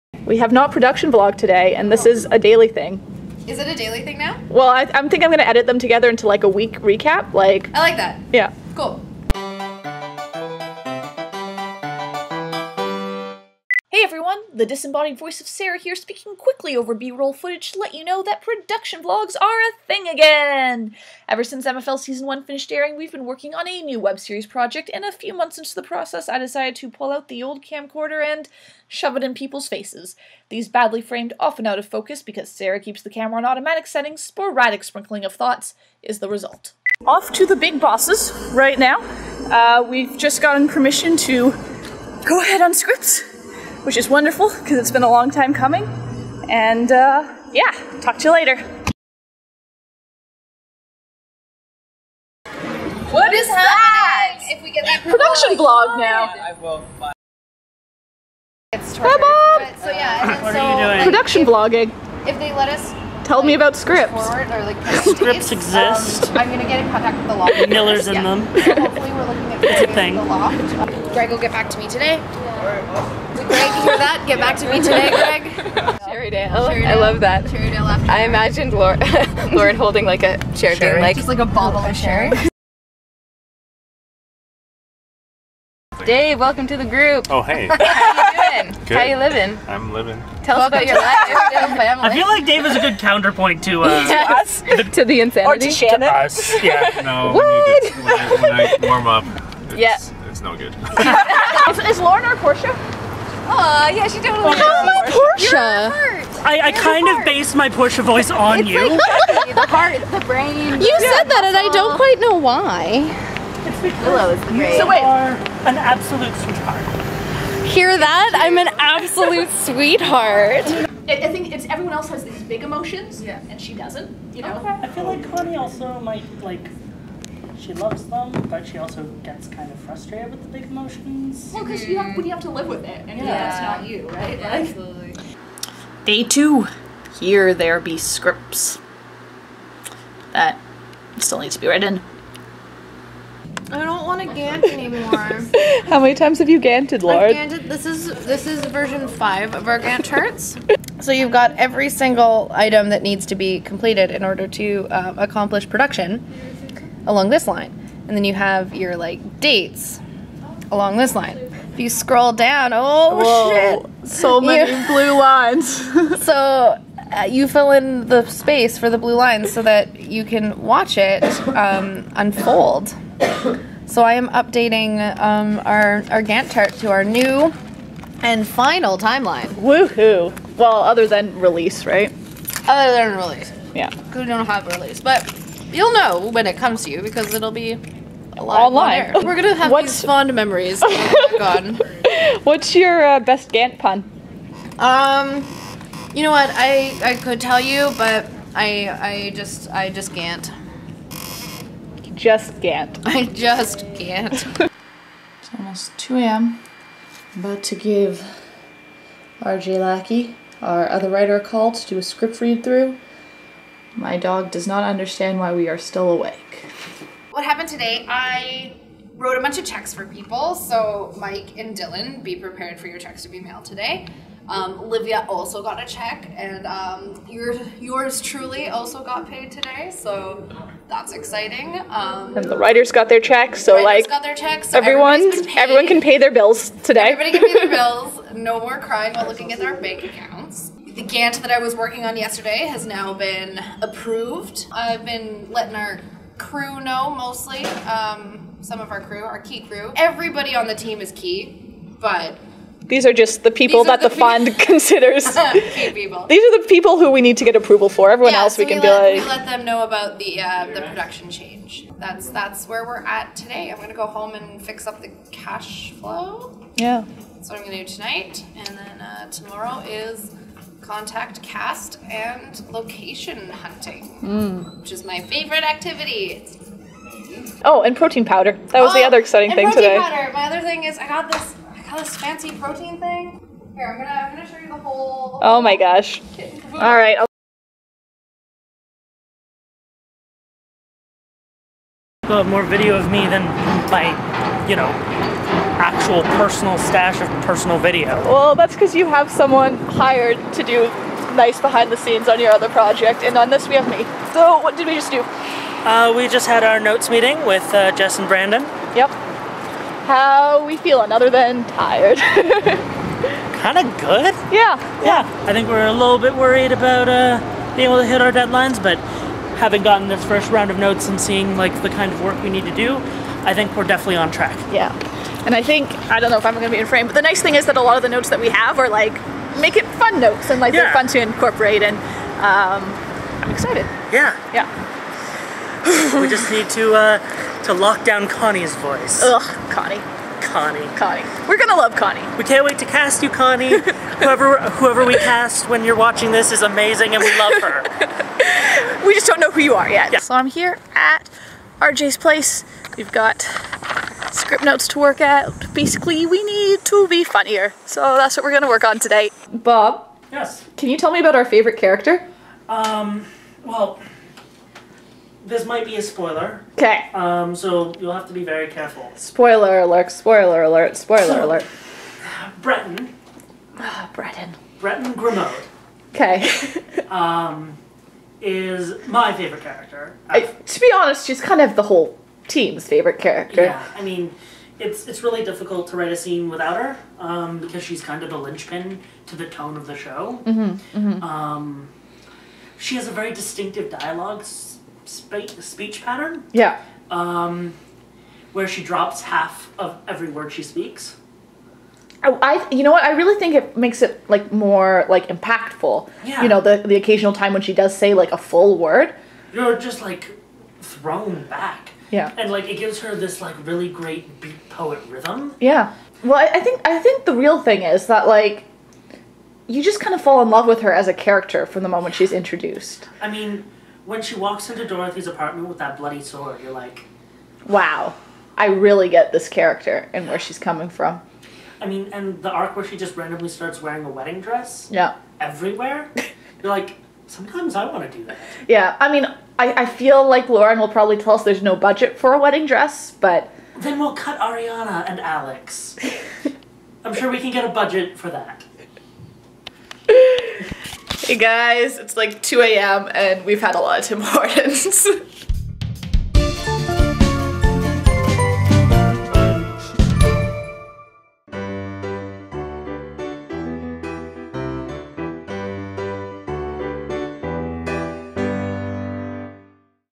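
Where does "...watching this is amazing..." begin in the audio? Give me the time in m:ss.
5:45.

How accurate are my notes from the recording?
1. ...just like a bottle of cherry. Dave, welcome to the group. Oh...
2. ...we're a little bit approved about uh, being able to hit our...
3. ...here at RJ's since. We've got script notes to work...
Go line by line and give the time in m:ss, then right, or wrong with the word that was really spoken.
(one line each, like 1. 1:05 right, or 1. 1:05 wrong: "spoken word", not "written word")
1. 1:21 right
2. 5:15 wrong: "worried", not "approved"
3. 5:50 wrong: "place", not "since".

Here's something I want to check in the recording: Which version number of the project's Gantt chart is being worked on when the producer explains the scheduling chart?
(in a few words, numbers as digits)
5.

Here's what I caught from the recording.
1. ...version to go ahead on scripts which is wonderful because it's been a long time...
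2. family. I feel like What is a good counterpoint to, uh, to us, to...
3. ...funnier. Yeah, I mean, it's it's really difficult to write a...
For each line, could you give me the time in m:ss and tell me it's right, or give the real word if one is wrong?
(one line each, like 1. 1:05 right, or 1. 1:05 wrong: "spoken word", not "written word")
1. 0:40 wrong: "permission", not "version"
2. 1:31 wrong: "Dave", not "What"
3. 6:23 wrong: "character", not "funnier".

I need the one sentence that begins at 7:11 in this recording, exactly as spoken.
I mean, and the arc where she just randomly starts wearing a wedding dress.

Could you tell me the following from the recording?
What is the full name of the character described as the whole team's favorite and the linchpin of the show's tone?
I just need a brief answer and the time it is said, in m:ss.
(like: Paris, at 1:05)
Breton Grimaud, at 6:14.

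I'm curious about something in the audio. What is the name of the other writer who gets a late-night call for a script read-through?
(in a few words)
R.J. Lackie.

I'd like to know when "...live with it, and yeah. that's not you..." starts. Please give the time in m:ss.
2:12.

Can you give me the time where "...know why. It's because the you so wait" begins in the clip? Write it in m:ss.
1:52.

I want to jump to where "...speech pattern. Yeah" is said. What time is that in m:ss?
6:35.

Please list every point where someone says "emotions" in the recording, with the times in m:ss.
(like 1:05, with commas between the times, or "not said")
2:02, 2:10.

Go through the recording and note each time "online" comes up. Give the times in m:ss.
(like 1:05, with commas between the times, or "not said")
3:08.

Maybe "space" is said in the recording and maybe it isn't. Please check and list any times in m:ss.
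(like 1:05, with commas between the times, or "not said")
1:05, 2:48.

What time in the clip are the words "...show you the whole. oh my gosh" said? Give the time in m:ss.
4:44.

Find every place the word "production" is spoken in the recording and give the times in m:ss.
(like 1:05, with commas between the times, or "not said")
0:00, 0:18, 0:55, 1:01, 2:35, 4:20.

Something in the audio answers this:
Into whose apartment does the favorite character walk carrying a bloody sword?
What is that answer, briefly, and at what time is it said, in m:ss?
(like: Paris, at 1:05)
Dorothy's, at 7:04.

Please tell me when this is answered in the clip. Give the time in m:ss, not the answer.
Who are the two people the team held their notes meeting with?
5:07.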